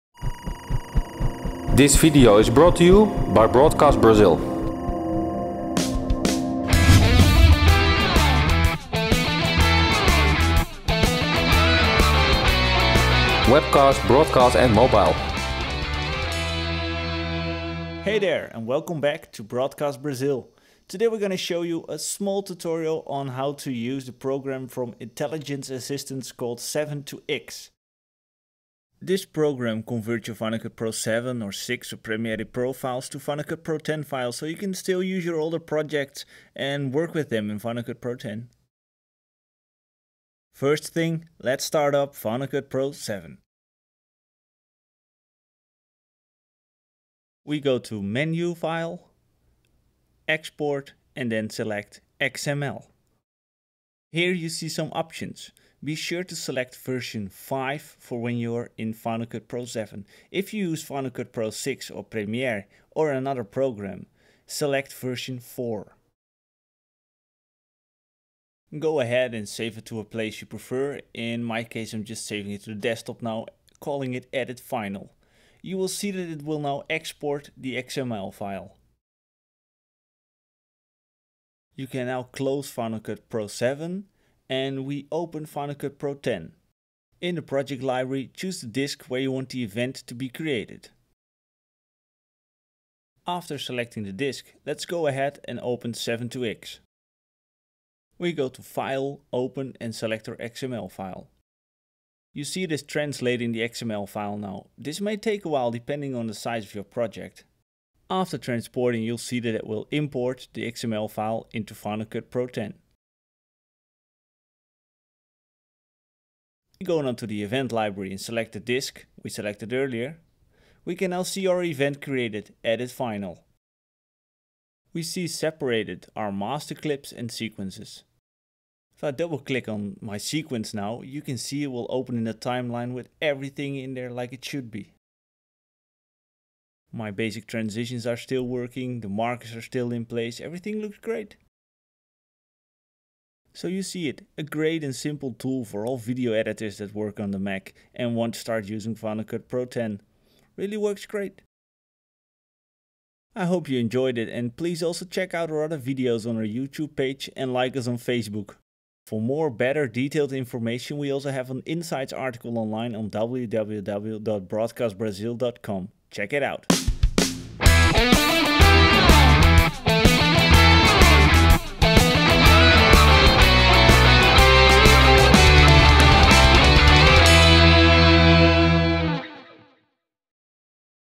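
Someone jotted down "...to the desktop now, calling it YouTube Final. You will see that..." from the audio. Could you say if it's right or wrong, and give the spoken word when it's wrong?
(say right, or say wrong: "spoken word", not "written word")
wrong: "Edit", not "YouTube".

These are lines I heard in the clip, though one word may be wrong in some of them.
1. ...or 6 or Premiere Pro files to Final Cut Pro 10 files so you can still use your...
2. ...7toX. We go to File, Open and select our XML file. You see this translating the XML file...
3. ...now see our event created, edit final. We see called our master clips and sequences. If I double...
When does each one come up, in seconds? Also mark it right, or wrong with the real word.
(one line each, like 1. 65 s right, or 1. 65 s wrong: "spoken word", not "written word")
1. 31 s right
2. 95 s right
3. 121 s wrong: "separated", not "called".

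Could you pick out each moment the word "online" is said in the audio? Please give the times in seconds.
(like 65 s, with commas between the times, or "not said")
162 s.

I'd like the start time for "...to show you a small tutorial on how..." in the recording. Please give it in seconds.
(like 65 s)
21 s.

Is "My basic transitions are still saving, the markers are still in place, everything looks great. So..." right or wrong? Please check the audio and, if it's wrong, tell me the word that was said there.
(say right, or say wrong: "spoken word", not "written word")
wrong: "working", not "saving".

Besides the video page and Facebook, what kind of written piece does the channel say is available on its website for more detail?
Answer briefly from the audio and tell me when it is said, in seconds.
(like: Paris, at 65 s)
insights article, at 161 s.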